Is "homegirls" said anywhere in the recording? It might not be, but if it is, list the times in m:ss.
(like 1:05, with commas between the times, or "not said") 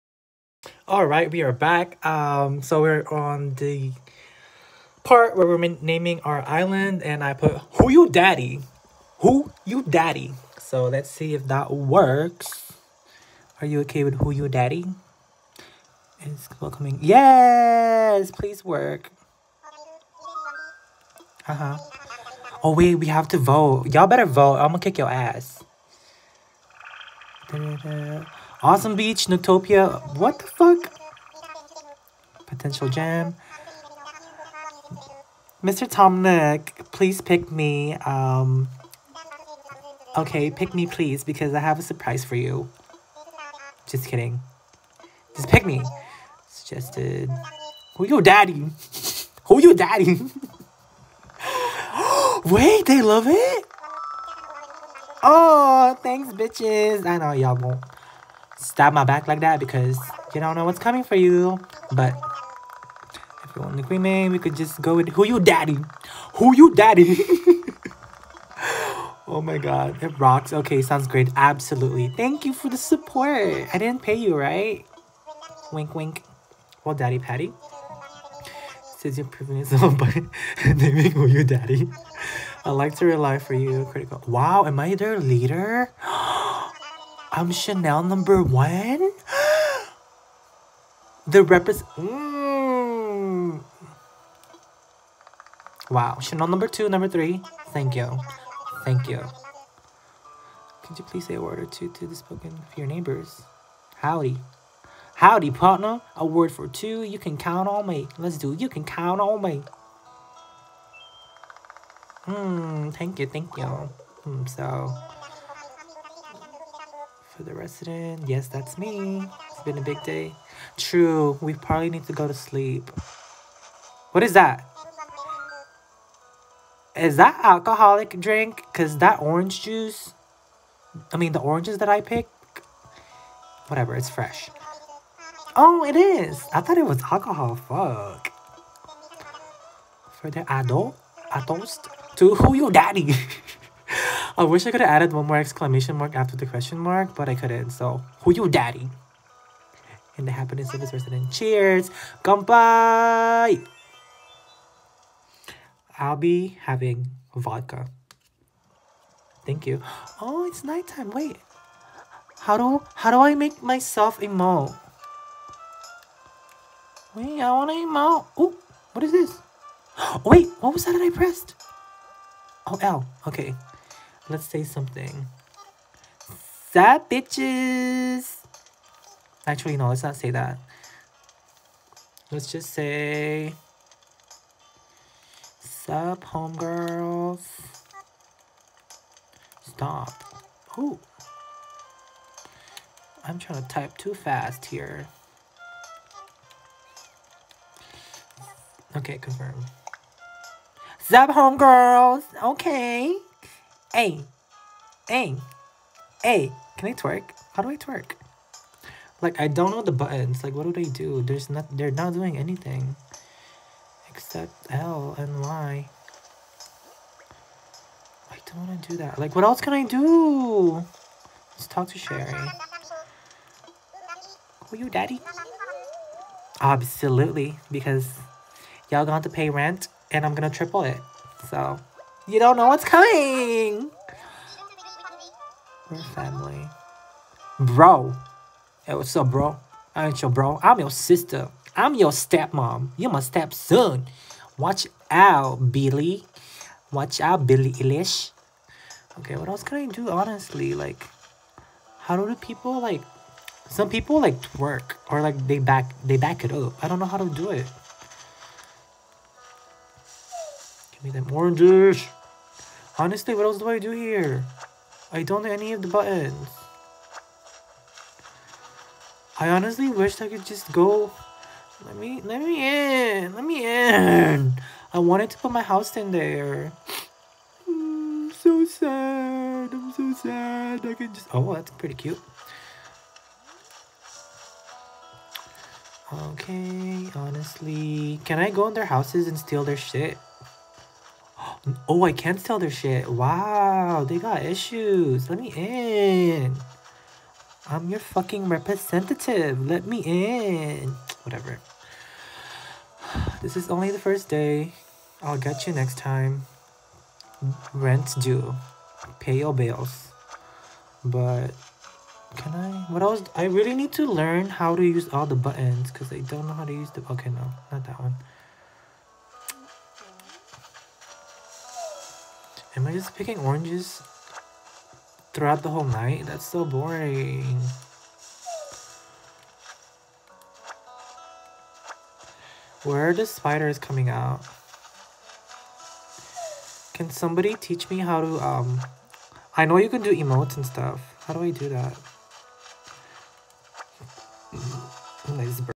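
3:06, 3:21.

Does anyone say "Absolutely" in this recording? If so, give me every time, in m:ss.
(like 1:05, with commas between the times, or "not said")
1:11, 3:46.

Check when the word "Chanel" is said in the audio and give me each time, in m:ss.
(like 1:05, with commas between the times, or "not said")
1:27, 1:36.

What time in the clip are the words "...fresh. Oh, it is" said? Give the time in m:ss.
2:14.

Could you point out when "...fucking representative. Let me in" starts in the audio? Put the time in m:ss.
4:57.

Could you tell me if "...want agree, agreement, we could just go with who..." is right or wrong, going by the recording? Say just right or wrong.
right.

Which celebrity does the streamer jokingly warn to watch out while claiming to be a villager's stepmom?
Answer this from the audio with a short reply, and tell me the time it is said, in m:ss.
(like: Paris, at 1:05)
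Billie Eilish, at 4:07.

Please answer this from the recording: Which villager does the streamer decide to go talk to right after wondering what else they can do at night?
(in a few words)
Sherry.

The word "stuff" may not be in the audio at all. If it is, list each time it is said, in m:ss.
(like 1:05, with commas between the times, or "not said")
5:40.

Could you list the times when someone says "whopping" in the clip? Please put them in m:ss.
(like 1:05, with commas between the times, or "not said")
not said.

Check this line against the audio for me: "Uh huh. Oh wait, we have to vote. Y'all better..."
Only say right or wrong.
right.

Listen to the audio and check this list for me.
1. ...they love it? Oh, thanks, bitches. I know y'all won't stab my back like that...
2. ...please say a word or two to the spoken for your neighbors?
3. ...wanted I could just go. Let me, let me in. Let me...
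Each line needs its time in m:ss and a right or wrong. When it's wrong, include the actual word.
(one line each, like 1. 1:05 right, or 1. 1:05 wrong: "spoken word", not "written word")
1. 0:52 right
2. 1:41 right
3. 4:29 wrong: "wished", not "wanted".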